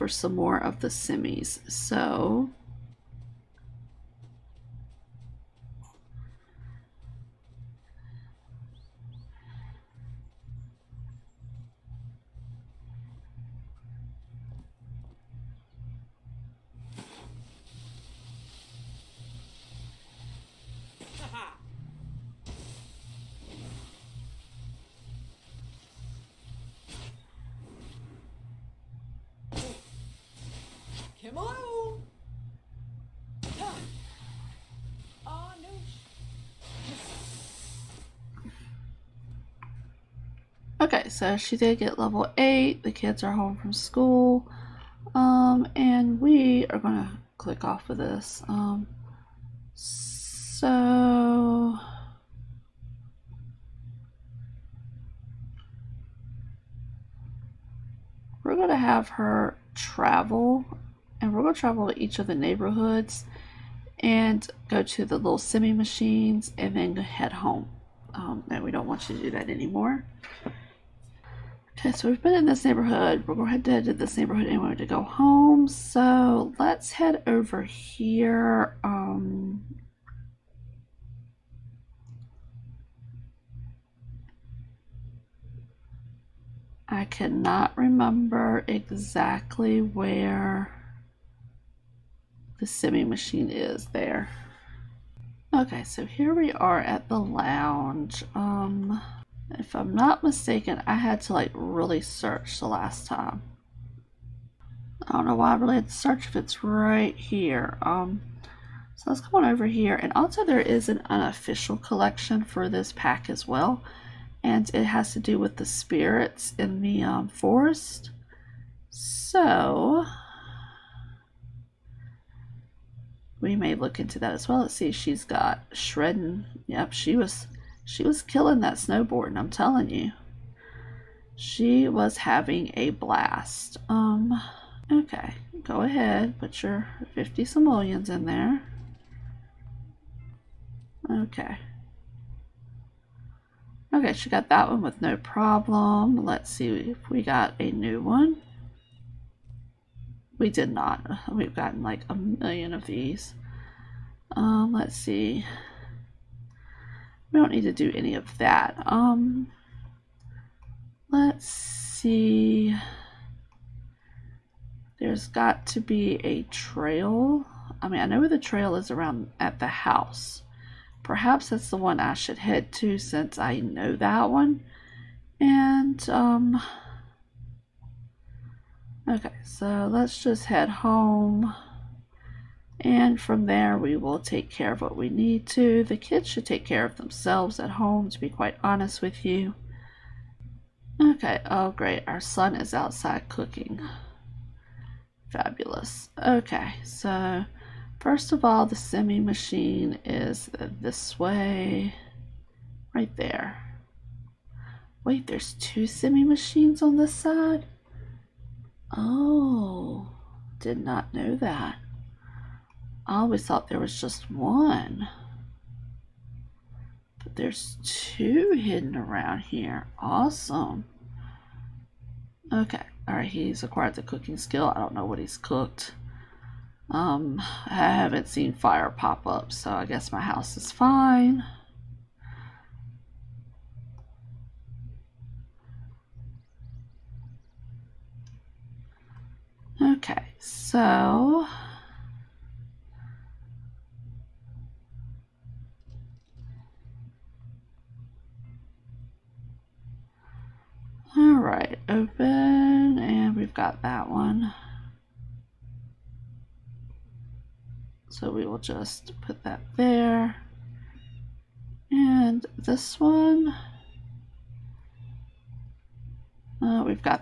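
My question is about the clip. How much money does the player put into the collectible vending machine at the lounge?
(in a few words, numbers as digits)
50 simoleons.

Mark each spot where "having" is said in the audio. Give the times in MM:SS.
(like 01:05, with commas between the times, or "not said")
02:12.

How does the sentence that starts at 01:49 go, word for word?
And also there is an unofficial collection for this pack as well.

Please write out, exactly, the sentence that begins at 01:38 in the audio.
Um, if I'm not mistaken, I had to like really search the last time.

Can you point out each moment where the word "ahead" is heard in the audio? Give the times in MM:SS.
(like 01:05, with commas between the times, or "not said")
02:15.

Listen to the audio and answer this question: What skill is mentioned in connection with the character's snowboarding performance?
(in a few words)
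Shredding.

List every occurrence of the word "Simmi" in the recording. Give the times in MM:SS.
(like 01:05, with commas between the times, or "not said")
00:00, 01:05, 01:32, 03:18, 03:25.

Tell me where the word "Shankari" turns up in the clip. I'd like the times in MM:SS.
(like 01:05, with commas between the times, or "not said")
not said.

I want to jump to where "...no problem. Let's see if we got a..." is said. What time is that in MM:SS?
02:25.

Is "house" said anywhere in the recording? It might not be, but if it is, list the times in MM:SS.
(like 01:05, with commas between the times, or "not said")
02:49, 03:50.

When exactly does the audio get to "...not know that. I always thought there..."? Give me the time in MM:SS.
03:30.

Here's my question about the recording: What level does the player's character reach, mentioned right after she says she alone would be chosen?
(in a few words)
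8.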